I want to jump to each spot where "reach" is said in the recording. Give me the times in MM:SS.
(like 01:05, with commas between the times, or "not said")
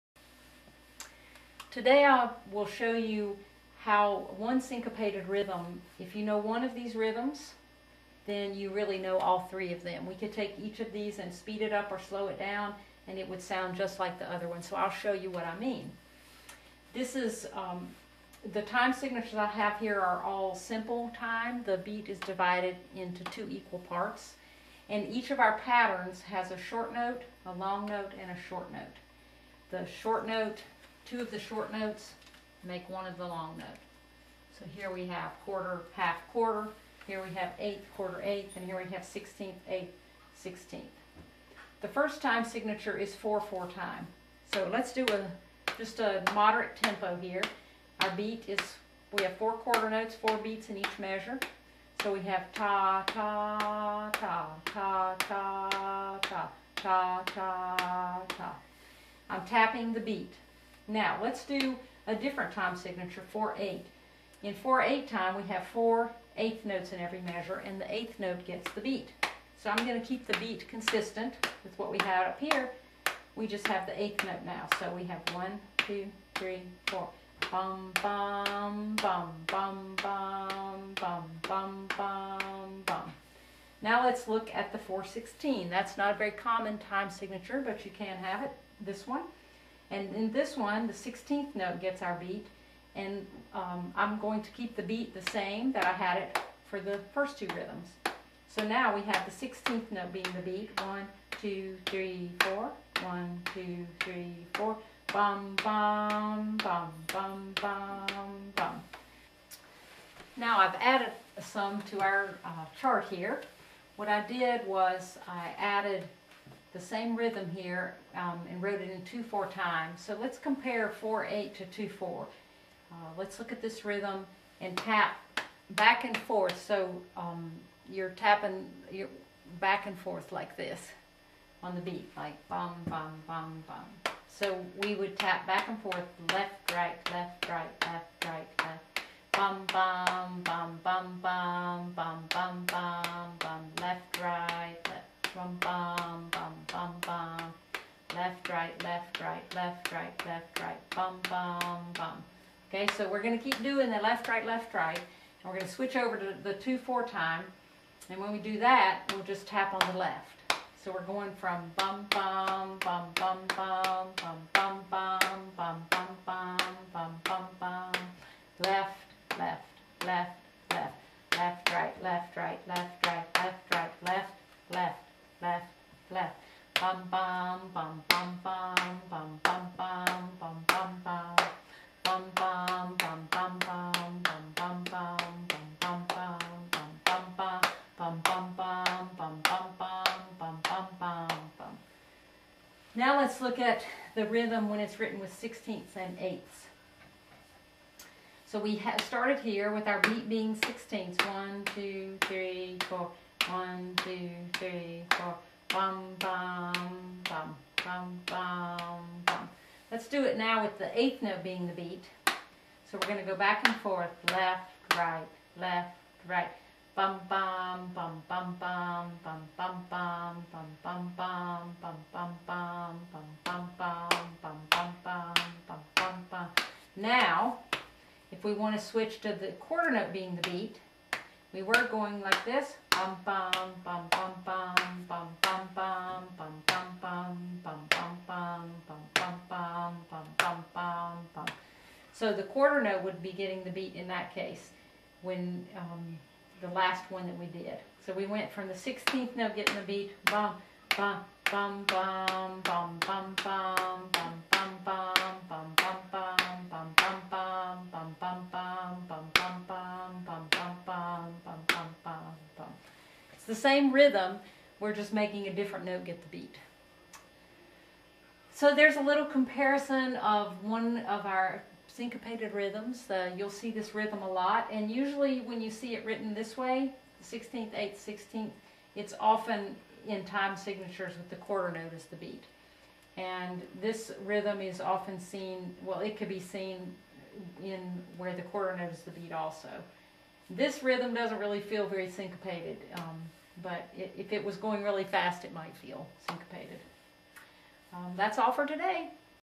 not said.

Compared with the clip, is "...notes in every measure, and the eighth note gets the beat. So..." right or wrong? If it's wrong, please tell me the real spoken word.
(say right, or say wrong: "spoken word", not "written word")
right.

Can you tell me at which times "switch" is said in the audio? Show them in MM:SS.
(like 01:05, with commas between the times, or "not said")
02:35.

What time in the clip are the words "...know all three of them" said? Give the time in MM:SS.
00:08.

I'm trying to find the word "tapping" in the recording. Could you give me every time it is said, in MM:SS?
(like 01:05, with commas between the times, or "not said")
00:59, 02:08.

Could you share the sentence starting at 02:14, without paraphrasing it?
So we would tap back and forth, left, right, left, right, left, right, left.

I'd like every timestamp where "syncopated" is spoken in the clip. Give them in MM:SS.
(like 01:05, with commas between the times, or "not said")
00:04, 04:31, 04:52, 04:56.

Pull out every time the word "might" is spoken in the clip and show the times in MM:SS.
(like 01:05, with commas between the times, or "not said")
04:55.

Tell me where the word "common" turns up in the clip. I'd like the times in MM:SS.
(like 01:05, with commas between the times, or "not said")
01:26.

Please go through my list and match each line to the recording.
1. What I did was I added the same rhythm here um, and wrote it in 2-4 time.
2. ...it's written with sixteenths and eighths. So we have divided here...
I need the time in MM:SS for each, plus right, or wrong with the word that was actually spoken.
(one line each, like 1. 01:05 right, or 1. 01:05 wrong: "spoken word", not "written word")
1. 01:53 right
2. 03:14 wrong: "started", not "divided".